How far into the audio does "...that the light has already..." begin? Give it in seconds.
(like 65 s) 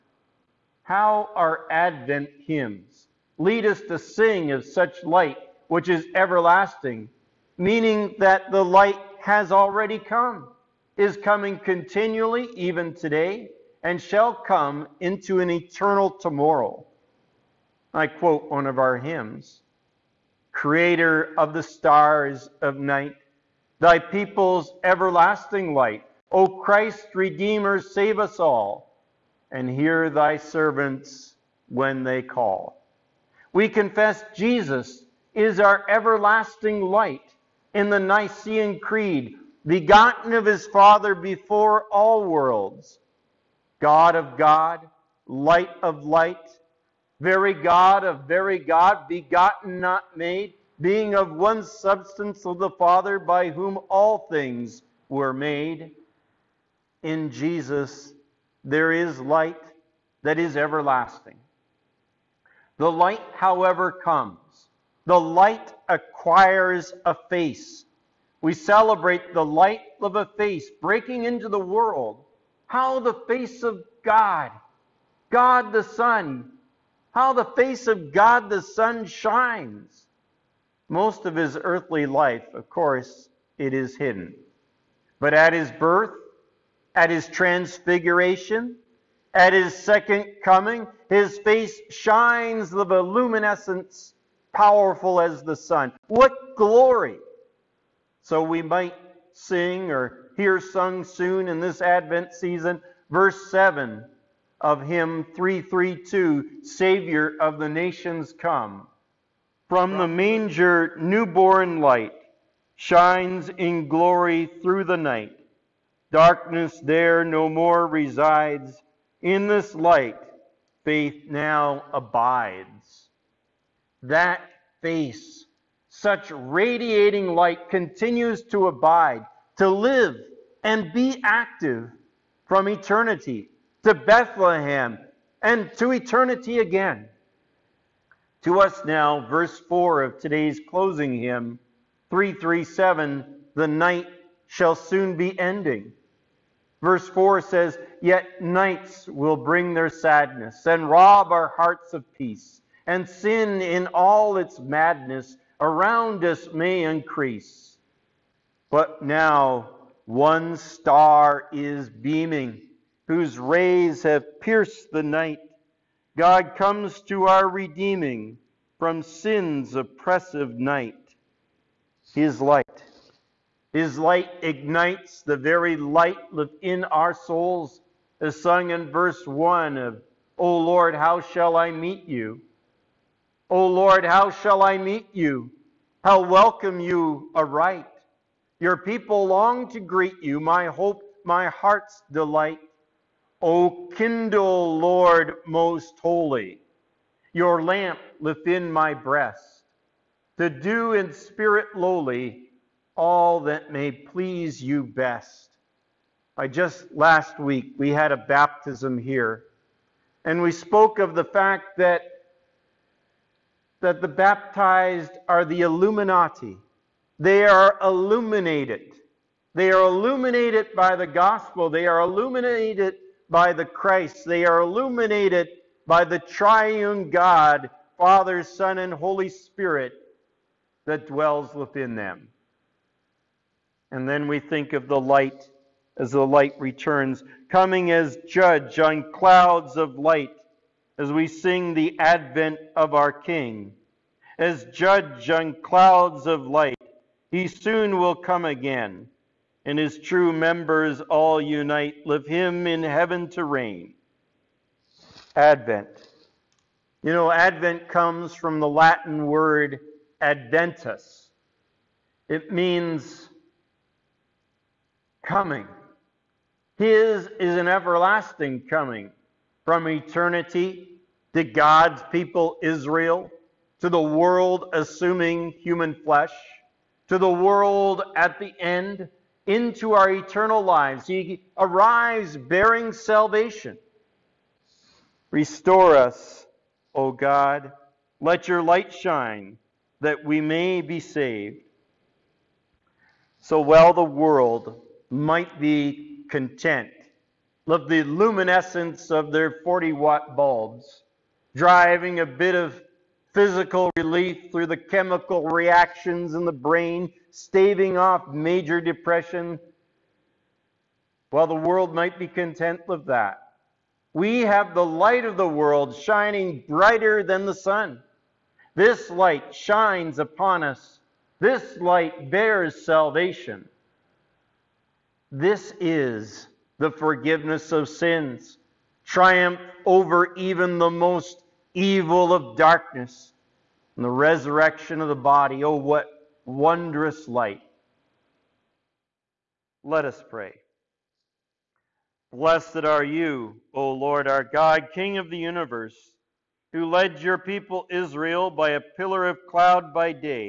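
8 s.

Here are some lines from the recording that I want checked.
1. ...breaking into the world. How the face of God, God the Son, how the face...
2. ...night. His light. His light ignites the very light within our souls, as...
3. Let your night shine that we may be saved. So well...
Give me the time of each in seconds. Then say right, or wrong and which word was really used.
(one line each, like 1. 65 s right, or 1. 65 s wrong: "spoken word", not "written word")
1. 70 s right
2. 170 s right
3. 288 s wrong: "light", not "night".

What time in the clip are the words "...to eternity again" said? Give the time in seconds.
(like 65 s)
135 s.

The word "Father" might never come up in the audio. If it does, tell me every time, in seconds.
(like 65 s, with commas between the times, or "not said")
40 s, 52 s, 227 s.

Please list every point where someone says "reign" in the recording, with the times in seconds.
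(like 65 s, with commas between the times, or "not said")
253 s.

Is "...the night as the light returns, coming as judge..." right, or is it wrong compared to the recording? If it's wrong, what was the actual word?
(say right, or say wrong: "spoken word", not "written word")
wrong: "light", not "night".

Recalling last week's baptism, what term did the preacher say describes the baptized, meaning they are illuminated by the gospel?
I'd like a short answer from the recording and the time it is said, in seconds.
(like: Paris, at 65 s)
the Illuminati, at 215 s.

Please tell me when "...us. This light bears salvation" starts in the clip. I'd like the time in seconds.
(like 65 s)
320 s.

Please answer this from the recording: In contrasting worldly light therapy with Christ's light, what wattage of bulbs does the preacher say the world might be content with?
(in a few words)
40 watt.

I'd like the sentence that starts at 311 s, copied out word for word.
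While the world might be content with that, we have the light of the world shining brighter than the sun.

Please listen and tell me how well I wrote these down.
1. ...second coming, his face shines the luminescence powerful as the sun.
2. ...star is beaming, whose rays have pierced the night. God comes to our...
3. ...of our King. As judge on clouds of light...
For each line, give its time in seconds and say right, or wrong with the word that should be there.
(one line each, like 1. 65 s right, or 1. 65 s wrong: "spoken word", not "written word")
1. 89 s right
2. 160 s right
3. 242 s right.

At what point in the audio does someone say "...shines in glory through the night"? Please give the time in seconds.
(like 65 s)
112 s.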